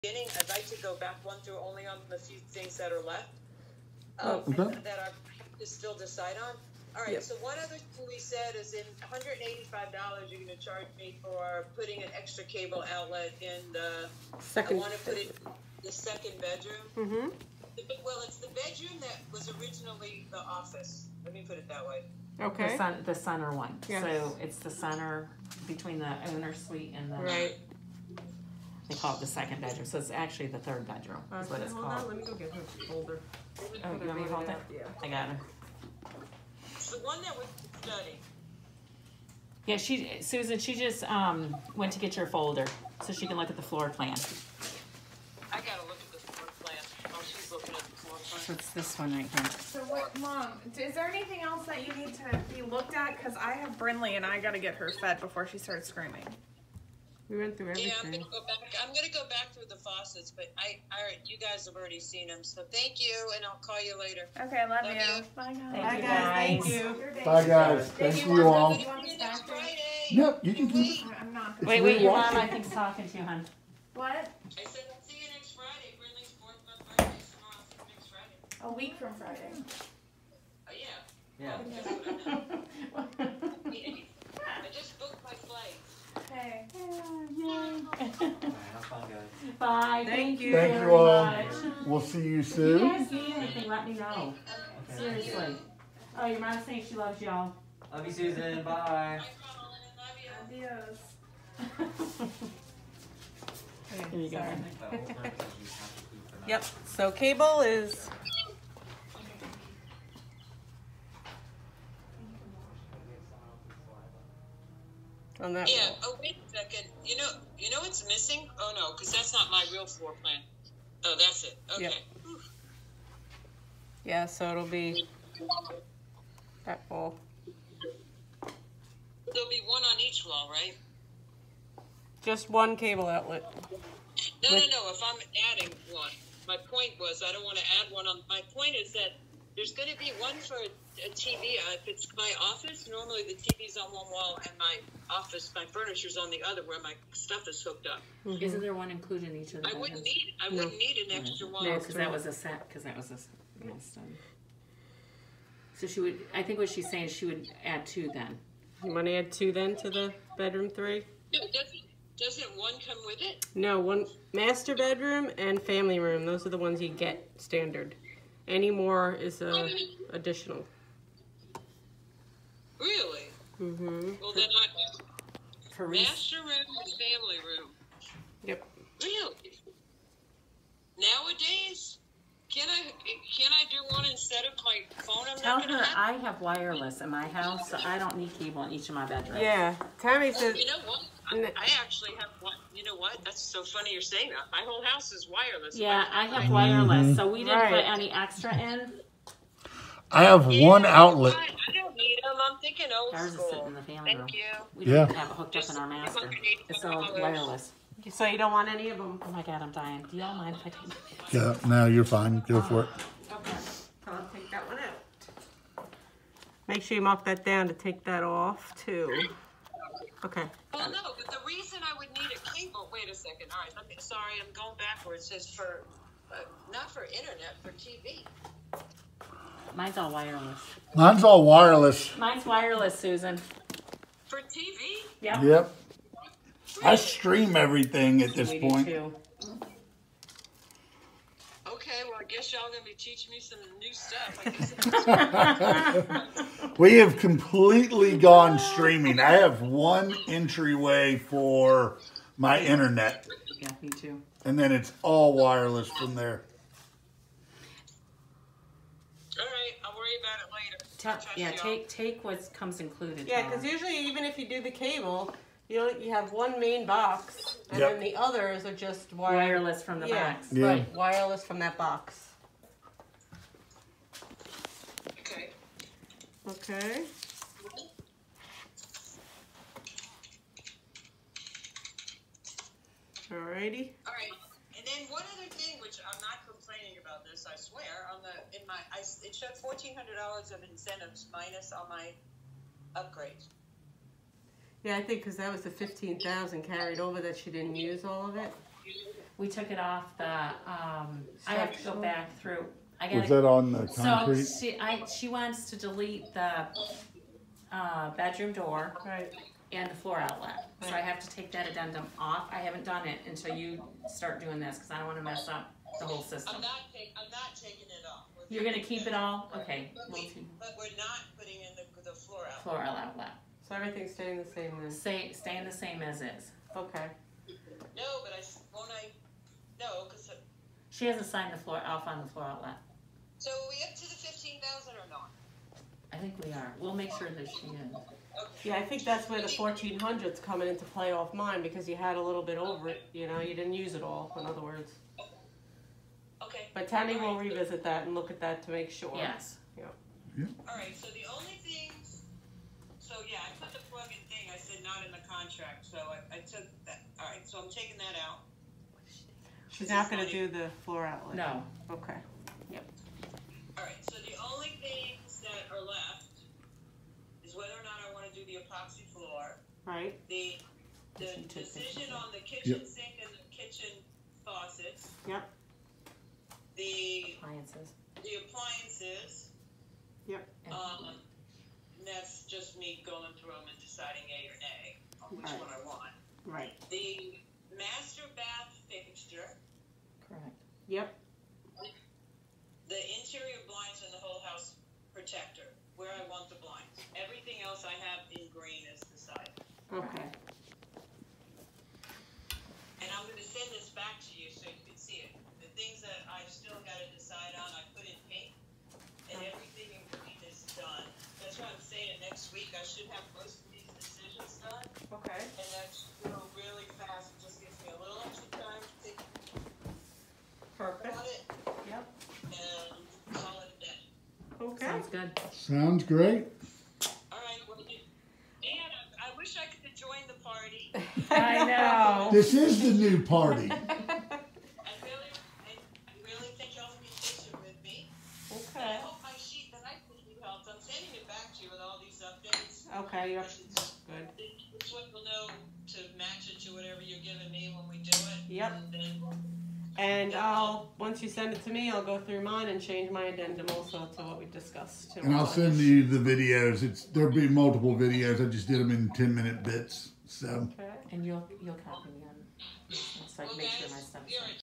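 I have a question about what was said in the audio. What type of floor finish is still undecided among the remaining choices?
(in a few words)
epoxy floor.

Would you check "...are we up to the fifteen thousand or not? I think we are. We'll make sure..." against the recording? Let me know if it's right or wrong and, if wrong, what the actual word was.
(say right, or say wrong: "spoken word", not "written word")
right.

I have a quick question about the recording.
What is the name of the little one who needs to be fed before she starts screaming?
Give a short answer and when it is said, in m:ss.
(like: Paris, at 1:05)
Brinley, at 0:53.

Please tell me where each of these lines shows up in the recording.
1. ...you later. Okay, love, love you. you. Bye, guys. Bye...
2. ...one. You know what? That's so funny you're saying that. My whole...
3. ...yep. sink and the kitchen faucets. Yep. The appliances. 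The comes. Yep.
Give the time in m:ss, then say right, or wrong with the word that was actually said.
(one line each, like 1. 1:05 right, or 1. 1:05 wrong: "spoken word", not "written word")
1. 1:03 right
2. 3:12 right
3. 6:12 wrong: "appliances", not "comes".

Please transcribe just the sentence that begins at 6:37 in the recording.
Everything else I have in green is the side.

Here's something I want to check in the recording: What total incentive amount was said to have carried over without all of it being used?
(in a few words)
15,000.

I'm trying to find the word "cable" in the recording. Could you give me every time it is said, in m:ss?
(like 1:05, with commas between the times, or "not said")
0:12, 1:47, 2:12, 3:08, 3:42, 4:24.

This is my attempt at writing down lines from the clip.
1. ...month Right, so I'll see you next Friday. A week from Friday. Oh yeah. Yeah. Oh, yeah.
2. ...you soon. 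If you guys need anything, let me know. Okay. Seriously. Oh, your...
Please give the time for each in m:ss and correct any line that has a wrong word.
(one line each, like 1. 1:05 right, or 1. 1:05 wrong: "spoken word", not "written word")
1. 1:16 wrong: "Friday", not "Right"
2. 1:32 right.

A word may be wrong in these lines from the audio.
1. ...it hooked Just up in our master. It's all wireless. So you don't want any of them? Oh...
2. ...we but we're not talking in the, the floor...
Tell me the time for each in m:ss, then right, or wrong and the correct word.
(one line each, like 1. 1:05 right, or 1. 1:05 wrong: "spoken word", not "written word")
1. 3:25 right
2. 5:20 wrong: "putting", not "talking".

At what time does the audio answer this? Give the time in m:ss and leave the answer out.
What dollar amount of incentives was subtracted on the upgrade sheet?
4:49.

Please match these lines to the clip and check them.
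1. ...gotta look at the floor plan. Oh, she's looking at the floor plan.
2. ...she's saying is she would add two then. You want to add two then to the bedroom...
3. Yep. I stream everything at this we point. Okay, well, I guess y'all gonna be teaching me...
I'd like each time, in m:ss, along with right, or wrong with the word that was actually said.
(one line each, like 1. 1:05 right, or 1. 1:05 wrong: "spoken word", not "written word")
1. 0:45 right
2. 2:36 right
3. 3:55 right.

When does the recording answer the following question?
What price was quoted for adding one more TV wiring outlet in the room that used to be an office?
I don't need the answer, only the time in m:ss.
0:09.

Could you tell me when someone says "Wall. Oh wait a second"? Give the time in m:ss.
1:55.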